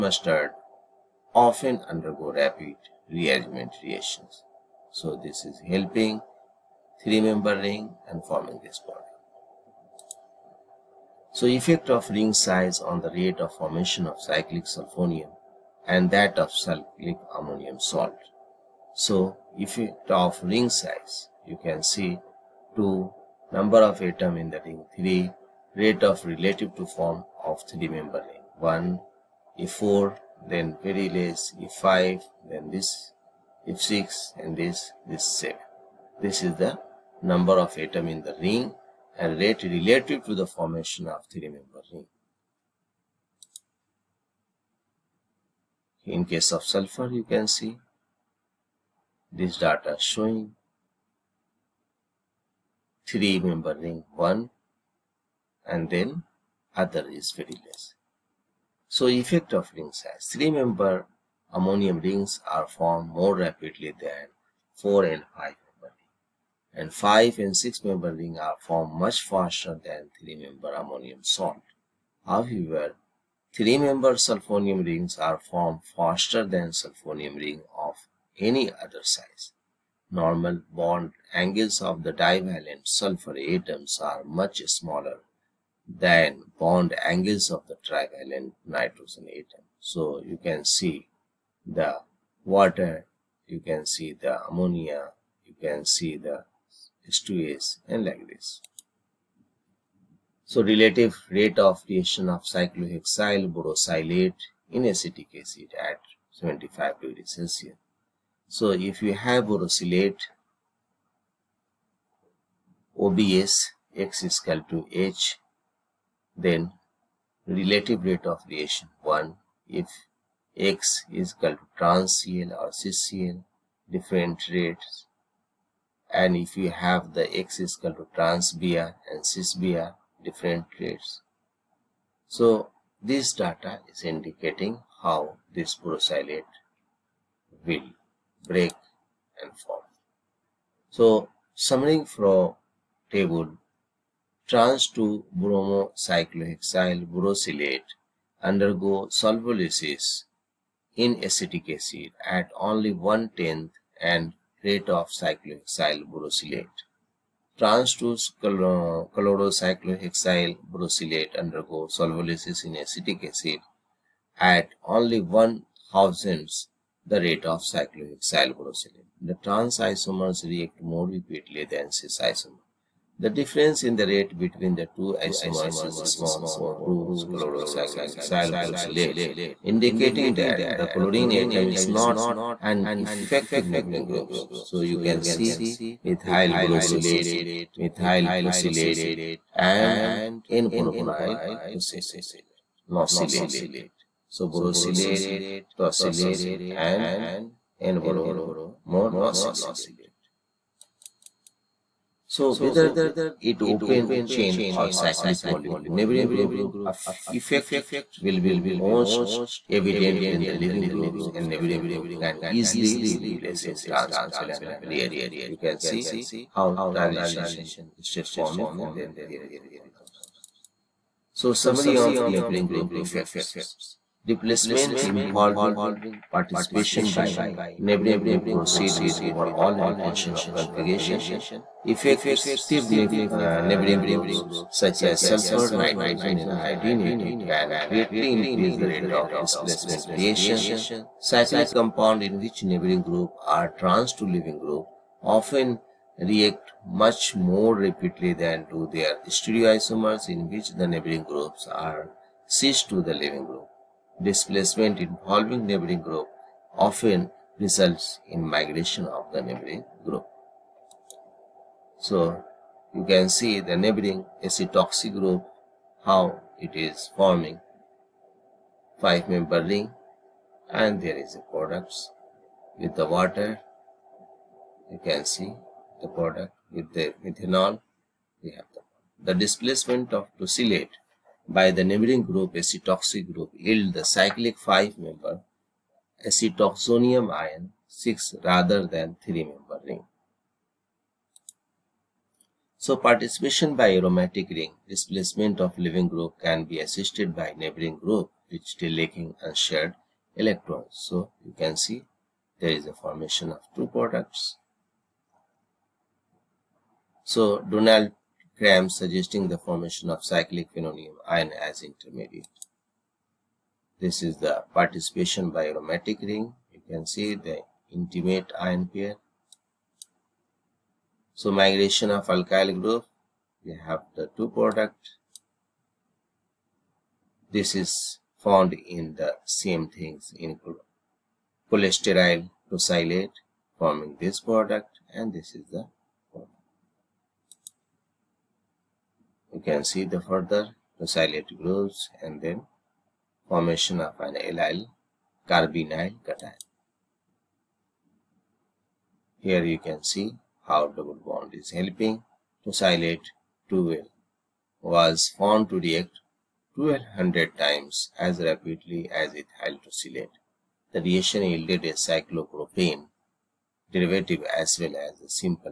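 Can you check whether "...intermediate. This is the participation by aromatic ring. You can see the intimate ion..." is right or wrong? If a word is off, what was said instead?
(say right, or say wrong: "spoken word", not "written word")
right.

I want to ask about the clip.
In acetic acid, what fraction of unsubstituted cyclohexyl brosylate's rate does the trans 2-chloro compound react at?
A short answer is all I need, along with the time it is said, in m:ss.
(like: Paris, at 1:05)
one thousandth, at 2:45.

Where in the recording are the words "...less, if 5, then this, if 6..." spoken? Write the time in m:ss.
0:31.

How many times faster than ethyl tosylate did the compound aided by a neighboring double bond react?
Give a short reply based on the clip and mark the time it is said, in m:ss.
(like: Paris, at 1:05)
1200, at 5:56.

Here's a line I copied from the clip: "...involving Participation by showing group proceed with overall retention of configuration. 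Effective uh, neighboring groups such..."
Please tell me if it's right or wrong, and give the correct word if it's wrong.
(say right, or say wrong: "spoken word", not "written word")
wrong: "neighboring", not "showing".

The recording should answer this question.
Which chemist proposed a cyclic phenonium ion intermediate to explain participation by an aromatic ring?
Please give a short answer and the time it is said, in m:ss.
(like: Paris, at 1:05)
Donald Cram, at 5:07.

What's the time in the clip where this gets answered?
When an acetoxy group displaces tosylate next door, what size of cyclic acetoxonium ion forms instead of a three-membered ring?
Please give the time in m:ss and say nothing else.
4:44.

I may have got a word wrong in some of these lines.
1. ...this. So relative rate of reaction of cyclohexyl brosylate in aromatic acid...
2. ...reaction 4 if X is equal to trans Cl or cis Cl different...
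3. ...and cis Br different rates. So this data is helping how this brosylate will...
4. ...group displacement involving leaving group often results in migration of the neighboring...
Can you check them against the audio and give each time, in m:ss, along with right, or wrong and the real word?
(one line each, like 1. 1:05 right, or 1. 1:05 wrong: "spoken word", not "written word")
1. 1:38 wrong: "acetic", not "aromatic"
2. 1:58 wrong: "1", not "4"
3. 2:09 wrong: "indicating", not "helping"
4. 4:13 wrong: "neighboring", not "leaving".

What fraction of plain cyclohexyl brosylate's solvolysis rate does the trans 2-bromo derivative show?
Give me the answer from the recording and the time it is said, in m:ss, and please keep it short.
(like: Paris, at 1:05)
one tenth, at 2:32.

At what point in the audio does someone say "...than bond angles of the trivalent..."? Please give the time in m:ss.
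1:25.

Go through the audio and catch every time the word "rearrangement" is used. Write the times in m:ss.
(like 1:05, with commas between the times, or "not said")
0:03, 3:34.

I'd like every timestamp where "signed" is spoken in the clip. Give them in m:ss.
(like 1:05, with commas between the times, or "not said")
not said.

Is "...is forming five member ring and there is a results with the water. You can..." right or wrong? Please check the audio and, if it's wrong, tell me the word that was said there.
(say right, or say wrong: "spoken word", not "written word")
wrong: "products", not "results".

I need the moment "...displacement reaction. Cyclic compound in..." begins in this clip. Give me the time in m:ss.
3:59.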